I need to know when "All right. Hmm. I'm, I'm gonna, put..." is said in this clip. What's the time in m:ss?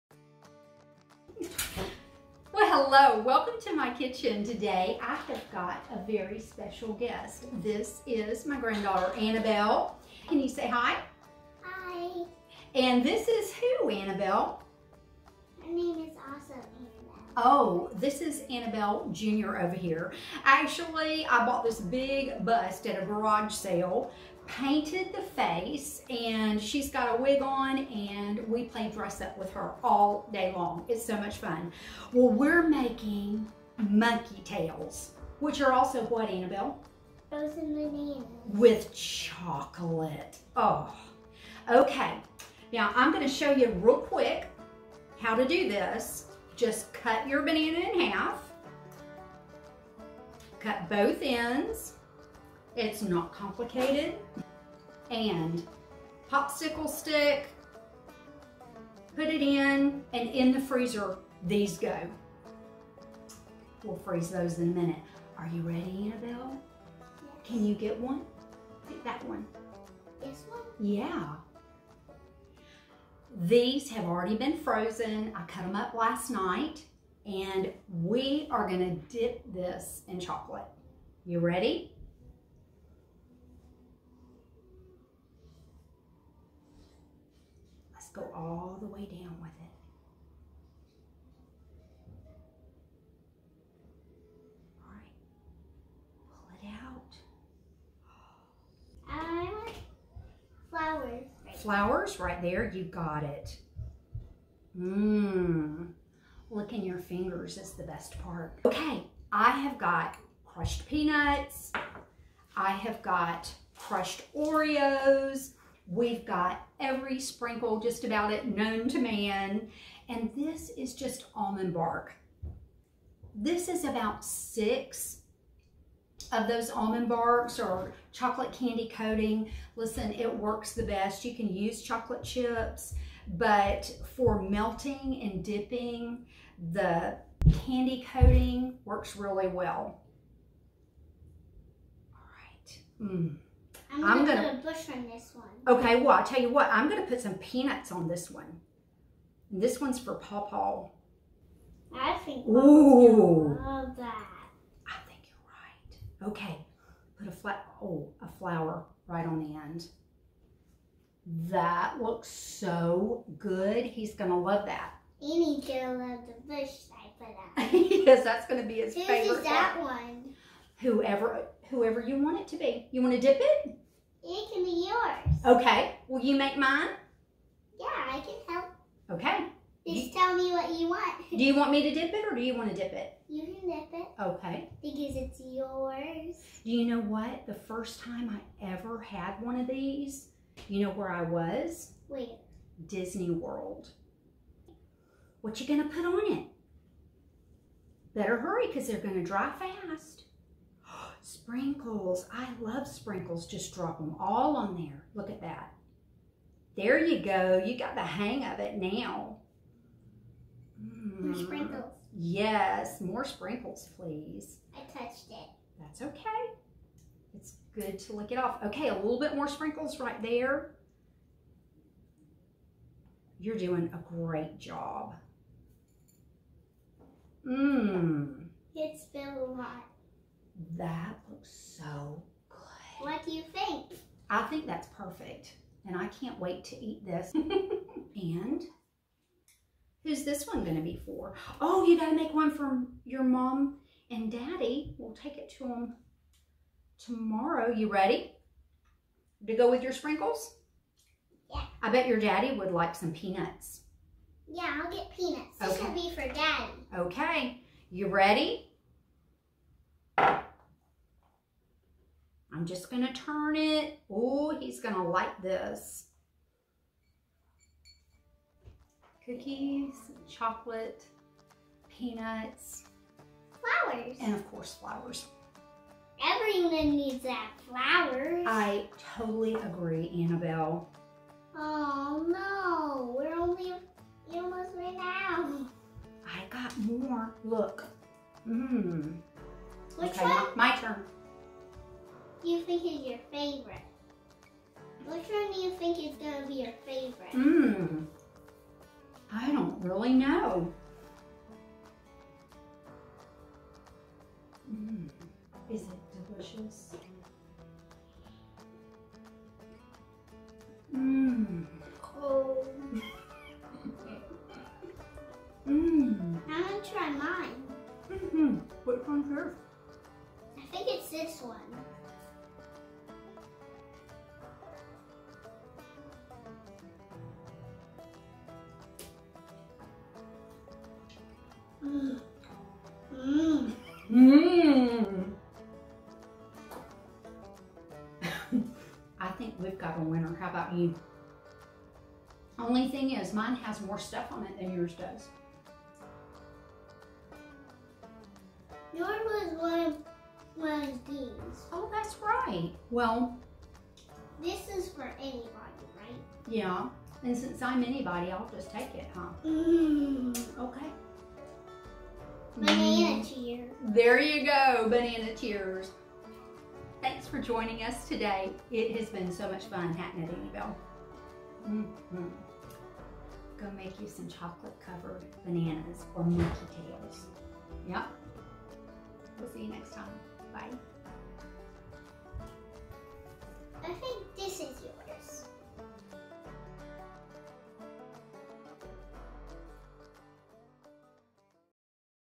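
2:22.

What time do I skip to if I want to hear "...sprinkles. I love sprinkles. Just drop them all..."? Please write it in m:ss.
3:21.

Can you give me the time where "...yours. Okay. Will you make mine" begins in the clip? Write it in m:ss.
2:54.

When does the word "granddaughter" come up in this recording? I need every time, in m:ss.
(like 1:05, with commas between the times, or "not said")
0:08.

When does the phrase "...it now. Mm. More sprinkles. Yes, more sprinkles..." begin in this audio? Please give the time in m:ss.
3:28.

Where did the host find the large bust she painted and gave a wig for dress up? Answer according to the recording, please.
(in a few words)
A garage sale.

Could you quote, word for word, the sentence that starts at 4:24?
Oh, he's going to like this.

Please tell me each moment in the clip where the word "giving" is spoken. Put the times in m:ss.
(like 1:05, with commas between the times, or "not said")
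not said.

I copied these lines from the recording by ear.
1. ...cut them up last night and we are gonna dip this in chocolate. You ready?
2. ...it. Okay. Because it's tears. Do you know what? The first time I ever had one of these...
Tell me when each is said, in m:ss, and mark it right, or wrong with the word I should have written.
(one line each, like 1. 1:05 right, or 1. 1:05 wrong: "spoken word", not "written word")
1. 1:15 right
2. 3:03 wrong: "yours", not "tears".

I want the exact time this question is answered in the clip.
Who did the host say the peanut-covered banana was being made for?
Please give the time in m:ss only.
2:30.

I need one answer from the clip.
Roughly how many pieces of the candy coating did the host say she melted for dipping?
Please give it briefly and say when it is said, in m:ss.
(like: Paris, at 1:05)
6, at 2:04.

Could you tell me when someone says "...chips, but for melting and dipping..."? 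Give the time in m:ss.
2:12.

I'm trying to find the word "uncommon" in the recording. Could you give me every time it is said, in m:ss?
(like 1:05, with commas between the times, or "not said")
not said.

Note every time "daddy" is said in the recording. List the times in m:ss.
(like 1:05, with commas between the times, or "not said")
4:04, 4:12, 4:16.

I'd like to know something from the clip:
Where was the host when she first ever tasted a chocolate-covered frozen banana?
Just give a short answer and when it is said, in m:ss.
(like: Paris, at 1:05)
Disney World, at 3:12.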